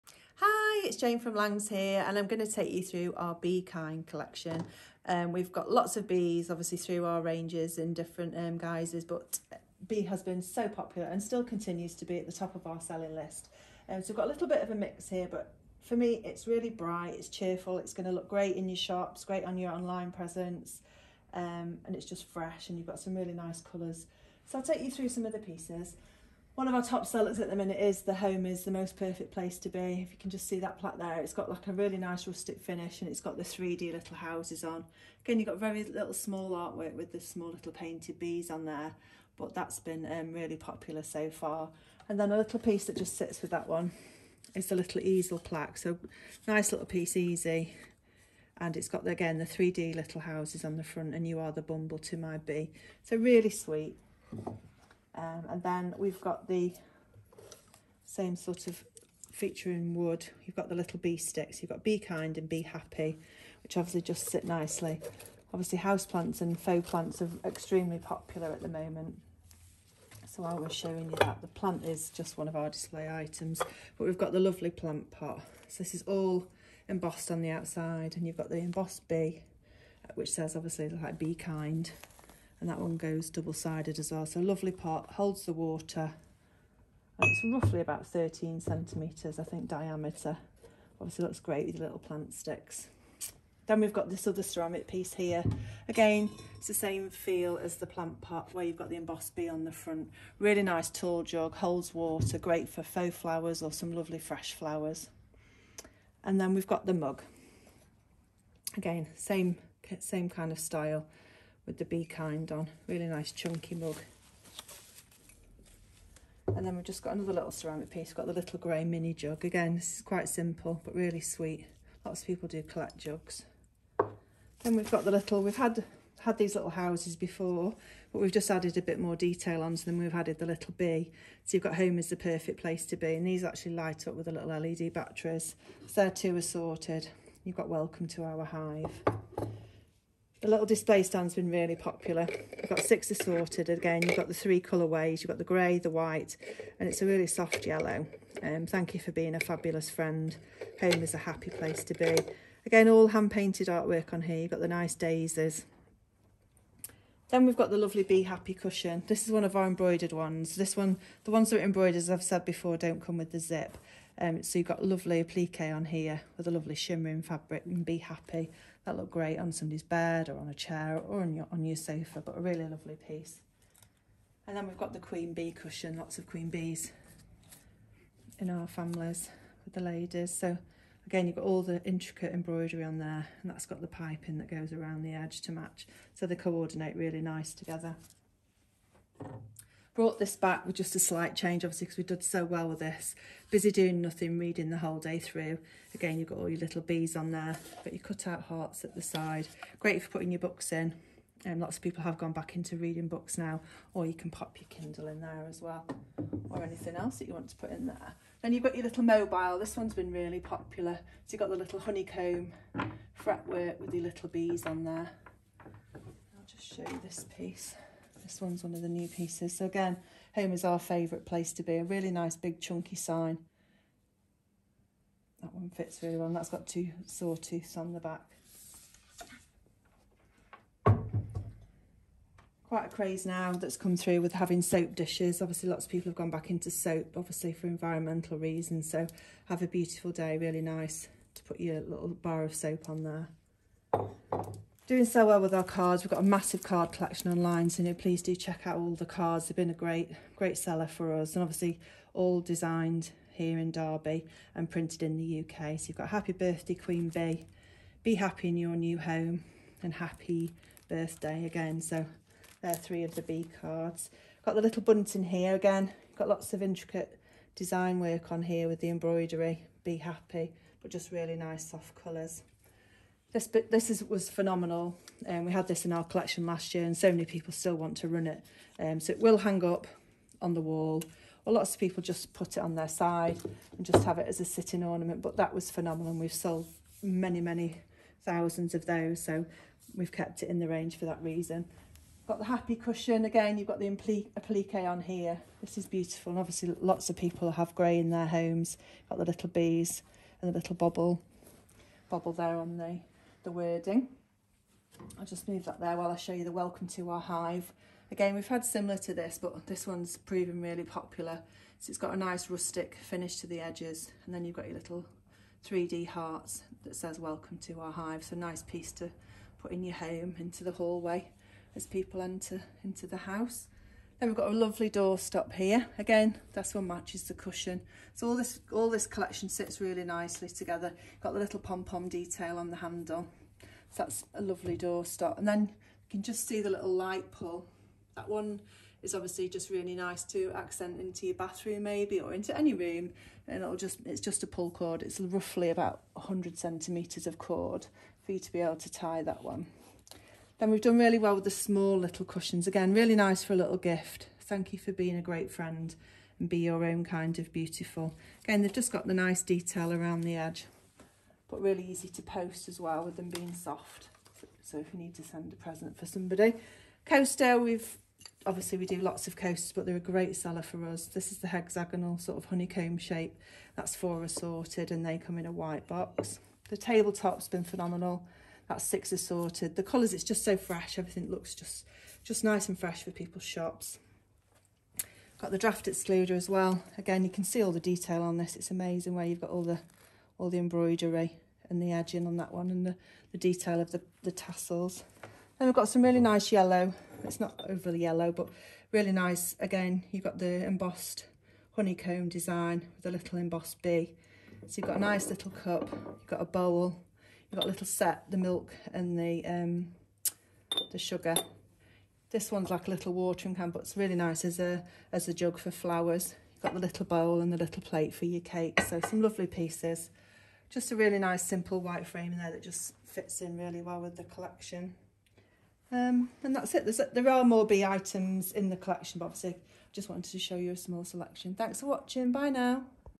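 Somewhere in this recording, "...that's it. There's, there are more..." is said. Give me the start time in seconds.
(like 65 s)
426 s.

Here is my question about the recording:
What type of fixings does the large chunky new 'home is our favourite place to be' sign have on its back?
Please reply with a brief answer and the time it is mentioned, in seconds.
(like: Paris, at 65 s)
two sawtooths, at 226 s.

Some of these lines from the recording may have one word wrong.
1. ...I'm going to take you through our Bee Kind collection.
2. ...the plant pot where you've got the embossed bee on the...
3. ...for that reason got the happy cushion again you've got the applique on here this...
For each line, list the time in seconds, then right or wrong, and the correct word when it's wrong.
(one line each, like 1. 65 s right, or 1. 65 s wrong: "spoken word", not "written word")
1. 2 s right
2. 97 s right
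3. 290 s right.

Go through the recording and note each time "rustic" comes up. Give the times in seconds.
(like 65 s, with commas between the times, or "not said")
32 s, 312 s.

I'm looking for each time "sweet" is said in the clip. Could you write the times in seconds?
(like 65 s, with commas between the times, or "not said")
53 s, 121 s.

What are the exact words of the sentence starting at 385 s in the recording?
Got the draft excluder as well.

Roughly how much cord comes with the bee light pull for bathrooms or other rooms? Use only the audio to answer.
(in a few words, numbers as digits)
100 centimetres.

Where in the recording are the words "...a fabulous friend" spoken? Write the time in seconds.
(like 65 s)
149 s.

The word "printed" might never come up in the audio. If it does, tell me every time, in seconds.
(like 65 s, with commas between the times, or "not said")
254 s.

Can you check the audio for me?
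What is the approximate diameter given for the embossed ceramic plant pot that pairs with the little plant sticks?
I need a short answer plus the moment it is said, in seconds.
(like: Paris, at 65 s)
13 centimetres, at 88 s.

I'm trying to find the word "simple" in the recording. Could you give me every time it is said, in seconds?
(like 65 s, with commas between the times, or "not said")
120 s, 421 s.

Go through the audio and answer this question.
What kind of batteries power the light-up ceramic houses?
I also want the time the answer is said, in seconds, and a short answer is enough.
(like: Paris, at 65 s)
LED batteries, at 134 s.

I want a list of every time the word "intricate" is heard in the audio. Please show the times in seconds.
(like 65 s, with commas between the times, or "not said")
181 s, 266 s.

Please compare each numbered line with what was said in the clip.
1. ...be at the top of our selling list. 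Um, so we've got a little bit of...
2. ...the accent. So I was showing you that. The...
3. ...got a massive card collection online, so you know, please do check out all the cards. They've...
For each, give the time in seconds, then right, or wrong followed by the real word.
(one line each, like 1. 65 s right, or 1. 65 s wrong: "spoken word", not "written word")
1. 12 s right
2. 68 s wrong: "moment", not "accent"
3. 246 s right.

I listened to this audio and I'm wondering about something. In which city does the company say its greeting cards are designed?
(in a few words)
Derby.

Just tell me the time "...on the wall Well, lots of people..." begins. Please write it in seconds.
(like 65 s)
280 s.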